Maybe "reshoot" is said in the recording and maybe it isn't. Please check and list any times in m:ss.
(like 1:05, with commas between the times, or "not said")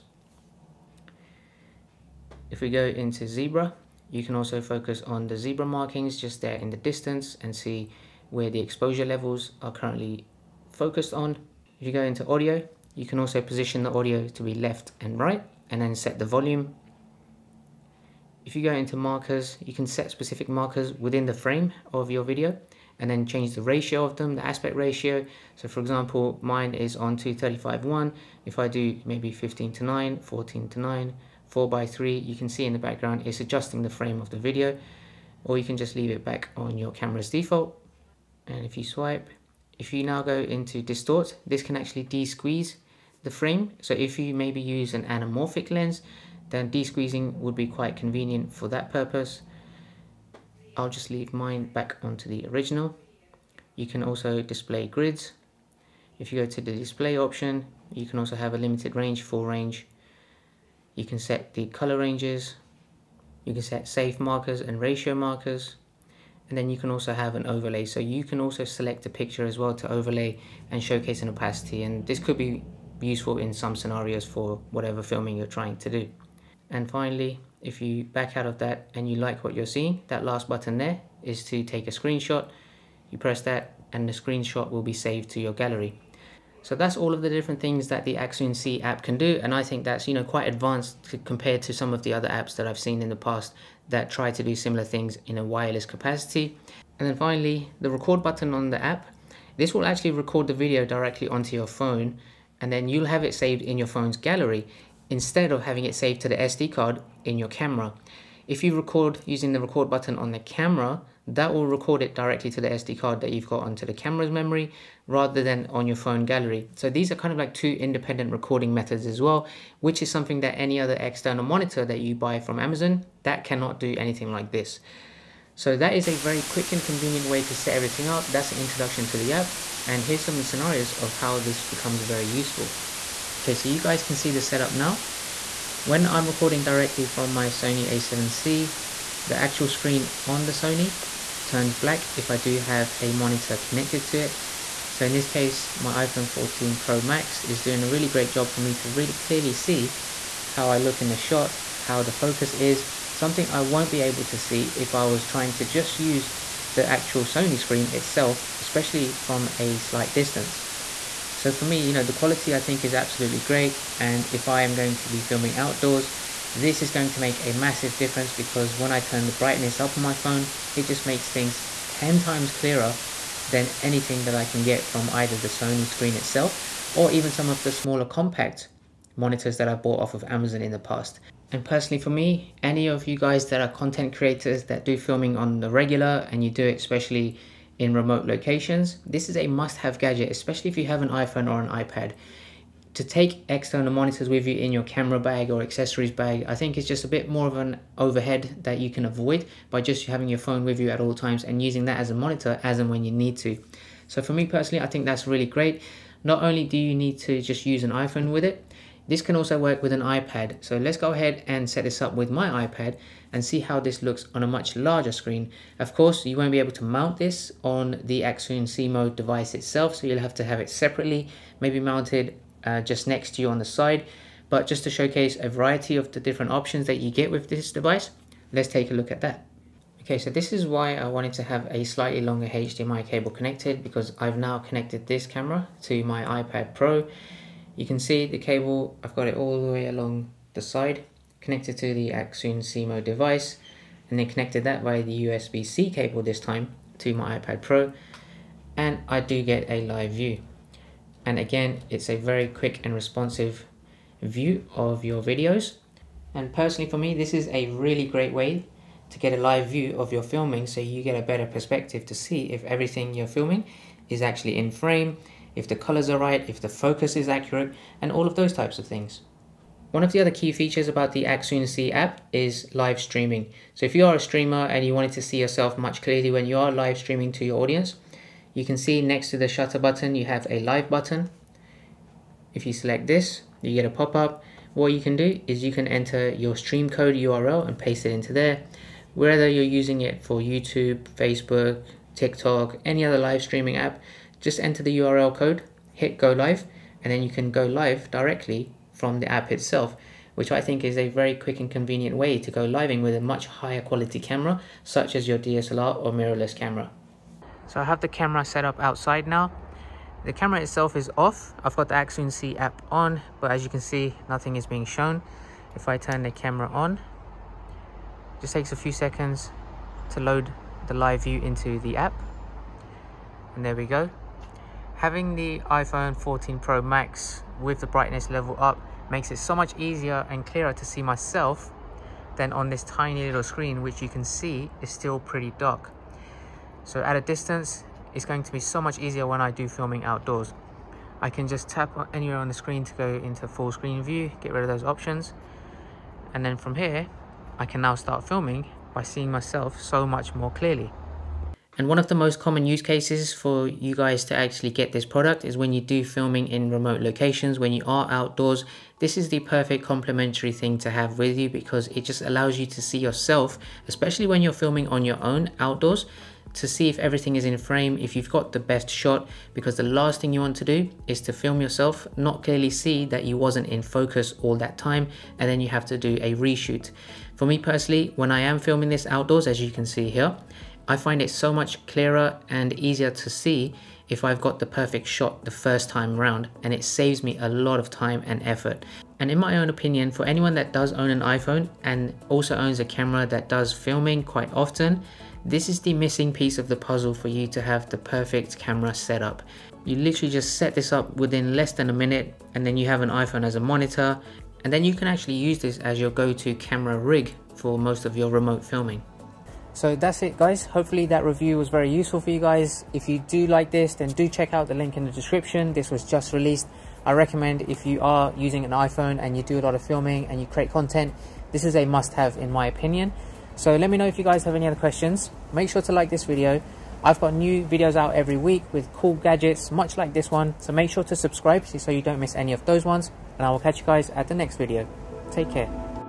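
6:16.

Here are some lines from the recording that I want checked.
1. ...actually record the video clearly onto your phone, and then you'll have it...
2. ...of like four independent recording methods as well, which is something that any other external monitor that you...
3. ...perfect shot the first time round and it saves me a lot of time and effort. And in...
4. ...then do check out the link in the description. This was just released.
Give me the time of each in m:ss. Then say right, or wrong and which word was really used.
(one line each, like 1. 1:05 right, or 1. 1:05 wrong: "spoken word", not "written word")
1. 1:39 wrong: "directly", not "clearly"
2. 1:57 wrong: "two", not "four"
3. 6:24 right
4. 6:53 right.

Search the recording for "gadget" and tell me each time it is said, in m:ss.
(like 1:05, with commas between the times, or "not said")
3:09, 7:09.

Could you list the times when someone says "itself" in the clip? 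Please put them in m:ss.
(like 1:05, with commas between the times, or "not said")
2:37, 2:56, 3:39, 4:59, 5:10.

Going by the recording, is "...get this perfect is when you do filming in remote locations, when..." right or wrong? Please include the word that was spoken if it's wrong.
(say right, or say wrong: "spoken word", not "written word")
wrong: "product", not "perfect".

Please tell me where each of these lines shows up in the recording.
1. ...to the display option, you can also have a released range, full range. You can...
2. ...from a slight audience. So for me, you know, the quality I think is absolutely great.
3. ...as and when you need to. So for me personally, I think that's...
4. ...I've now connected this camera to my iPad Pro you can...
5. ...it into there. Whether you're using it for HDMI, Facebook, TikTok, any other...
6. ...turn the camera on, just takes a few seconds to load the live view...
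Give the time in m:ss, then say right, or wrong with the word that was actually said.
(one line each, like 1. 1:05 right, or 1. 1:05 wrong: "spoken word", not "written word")
1. 0:56 wrong: "limited", not "released"
2. 2:39 wrong: "distance", not "audience"
3. 3:22 right
4. 3:54 right
5. 4:48 wrong: "YouTube", not "HDMI"
6. 5:15 right.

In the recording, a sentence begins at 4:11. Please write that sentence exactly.
And again, it's a very quick and responsive view of your videos.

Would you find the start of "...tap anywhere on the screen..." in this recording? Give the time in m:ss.
5:41.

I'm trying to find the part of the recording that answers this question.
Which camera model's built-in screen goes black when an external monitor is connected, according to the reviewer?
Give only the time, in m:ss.
2:17.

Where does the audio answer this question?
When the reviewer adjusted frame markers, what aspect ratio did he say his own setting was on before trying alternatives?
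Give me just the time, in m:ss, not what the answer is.
0:27.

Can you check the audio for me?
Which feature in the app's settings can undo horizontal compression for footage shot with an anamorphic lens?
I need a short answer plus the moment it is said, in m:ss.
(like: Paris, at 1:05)
Distort, at 0:40.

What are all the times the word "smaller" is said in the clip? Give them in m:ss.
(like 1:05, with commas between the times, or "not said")
2:57.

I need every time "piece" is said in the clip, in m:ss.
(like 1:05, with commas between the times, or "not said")
6:36.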